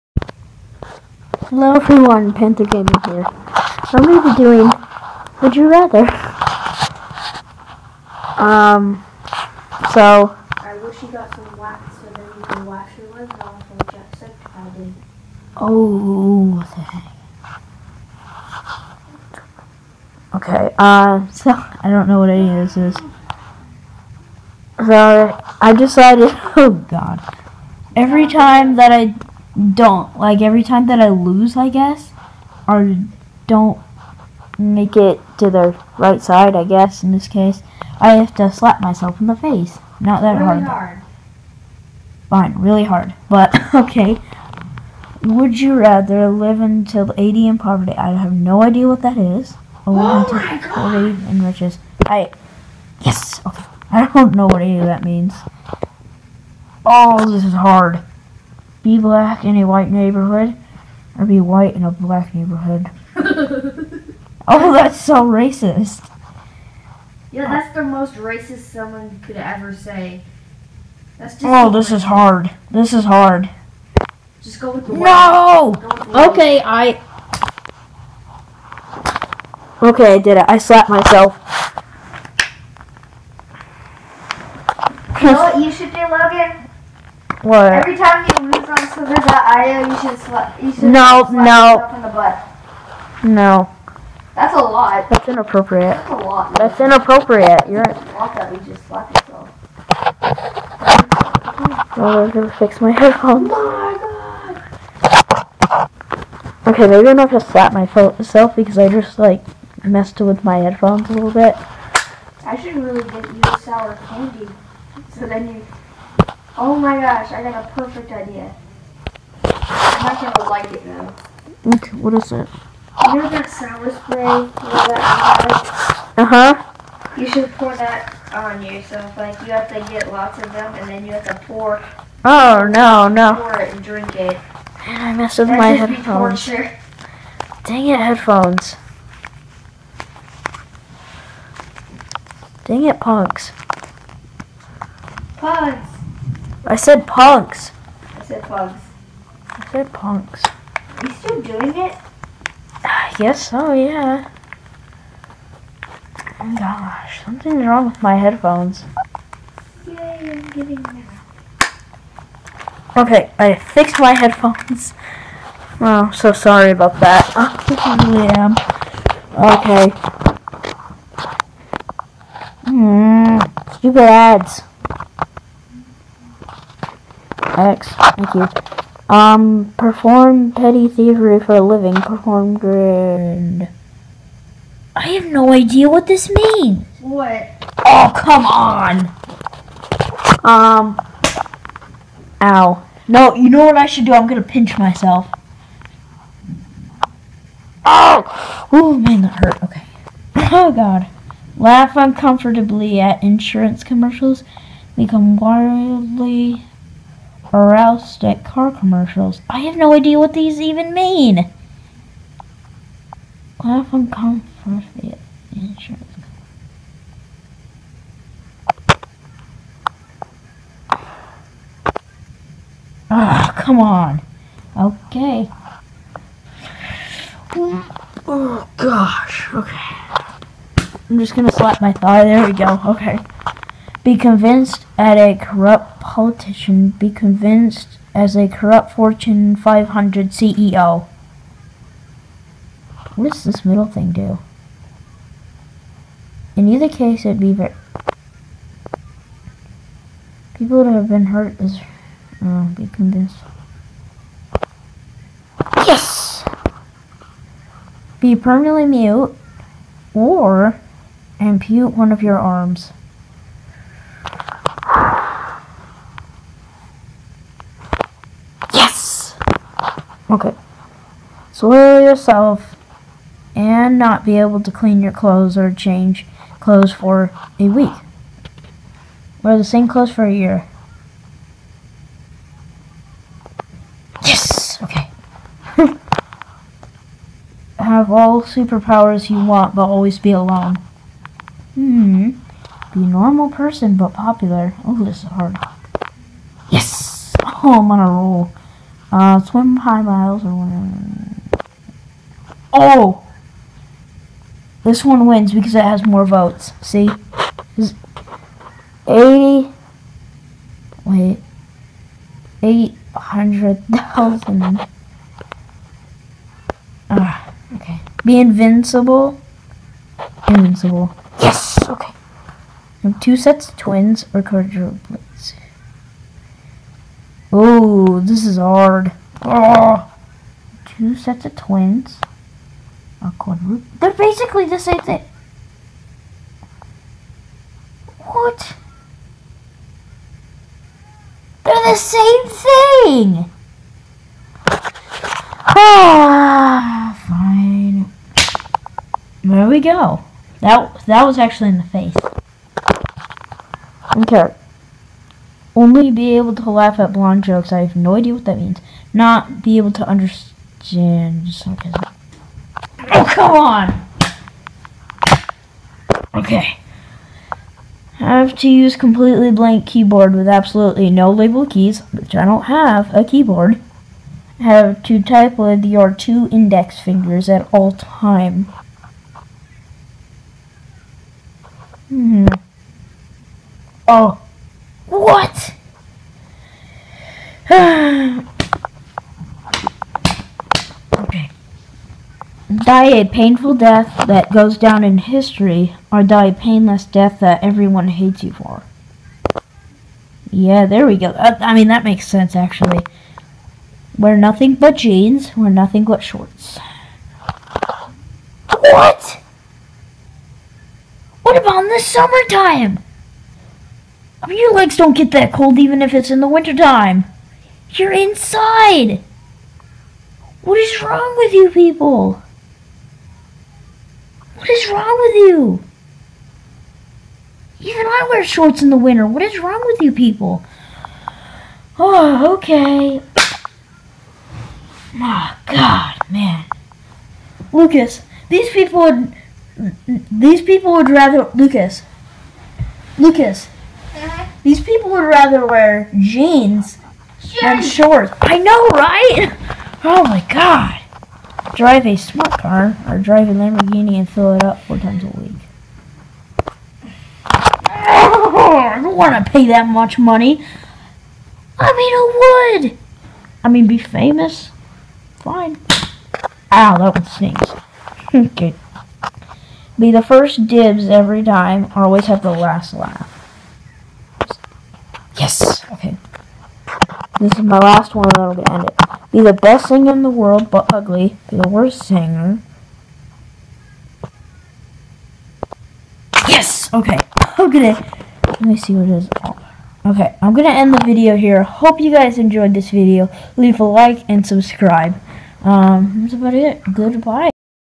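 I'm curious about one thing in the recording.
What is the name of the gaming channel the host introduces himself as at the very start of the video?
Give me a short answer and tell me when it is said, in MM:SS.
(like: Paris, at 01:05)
Panther Gaming, at 00:02.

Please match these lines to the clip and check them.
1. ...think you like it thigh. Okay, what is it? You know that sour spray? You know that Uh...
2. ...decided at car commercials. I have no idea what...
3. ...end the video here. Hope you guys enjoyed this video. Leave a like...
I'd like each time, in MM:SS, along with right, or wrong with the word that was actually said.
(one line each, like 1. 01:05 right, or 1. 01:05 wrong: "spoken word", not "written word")
1. 02:00 wrong: "though", not "thigh"
2. 03:27 wrong: "aroused", not "decided"
3. 08:10 right.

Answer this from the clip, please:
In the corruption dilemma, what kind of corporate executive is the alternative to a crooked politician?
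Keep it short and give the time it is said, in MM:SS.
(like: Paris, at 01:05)
Fortune 500 CEO, at 03:58.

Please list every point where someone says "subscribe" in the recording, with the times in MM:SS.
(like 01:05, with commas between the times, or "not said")
08:14.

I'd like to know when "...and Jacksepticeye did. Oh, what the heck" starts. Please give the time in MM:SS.
00:13.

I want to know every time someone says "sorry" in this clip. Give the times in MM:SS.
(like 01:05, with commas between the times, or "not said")
02:46.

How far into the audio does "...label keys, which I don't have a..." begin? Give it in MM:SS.
06:11.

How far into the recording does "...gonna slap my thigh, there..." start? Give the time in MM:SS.
03:51.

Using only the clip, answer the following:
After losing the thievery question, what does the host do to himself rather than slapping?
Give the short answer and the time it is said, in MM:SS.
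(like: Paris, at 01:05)
pinch myself, at 03:14.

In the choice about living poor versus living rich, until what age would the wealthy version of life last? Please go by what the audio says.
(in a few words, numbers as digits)
40.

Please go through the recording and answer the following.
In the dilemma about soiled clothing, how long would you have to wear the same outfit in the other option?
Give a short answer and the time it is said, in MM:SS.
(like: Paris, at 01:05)
a year, at 04:40.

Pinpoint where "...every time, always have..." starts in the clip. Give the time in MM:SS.
07:51.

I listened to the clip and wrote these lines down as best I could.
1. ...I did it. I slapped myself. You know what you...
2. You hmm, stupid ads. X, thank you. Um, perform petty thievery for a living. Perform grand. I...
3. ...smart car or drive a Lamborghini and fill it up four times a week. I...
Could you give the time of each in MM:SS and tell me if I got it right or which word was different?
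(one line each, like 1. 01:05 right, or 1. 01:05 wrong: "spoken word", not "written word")
1. 01:20 right
2. 02:52 right
3. 07:32 right.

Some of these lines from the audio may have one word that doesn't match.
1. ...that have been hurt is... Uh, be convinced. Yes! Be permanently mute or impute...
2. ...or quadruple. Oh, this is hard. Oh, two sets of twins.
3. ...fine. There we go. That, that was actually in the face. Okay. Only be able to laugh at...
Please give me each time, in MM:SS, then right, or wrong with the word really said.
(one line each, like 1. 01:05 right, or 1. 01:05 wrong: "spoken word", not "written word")
1. 04:10 right
2. 05:24 right
3. 05:47 right.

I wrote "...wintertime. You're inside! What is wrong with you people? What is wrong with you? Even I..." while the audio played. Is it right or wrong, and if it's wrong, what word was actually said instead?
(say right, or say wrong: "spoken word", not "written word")
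right.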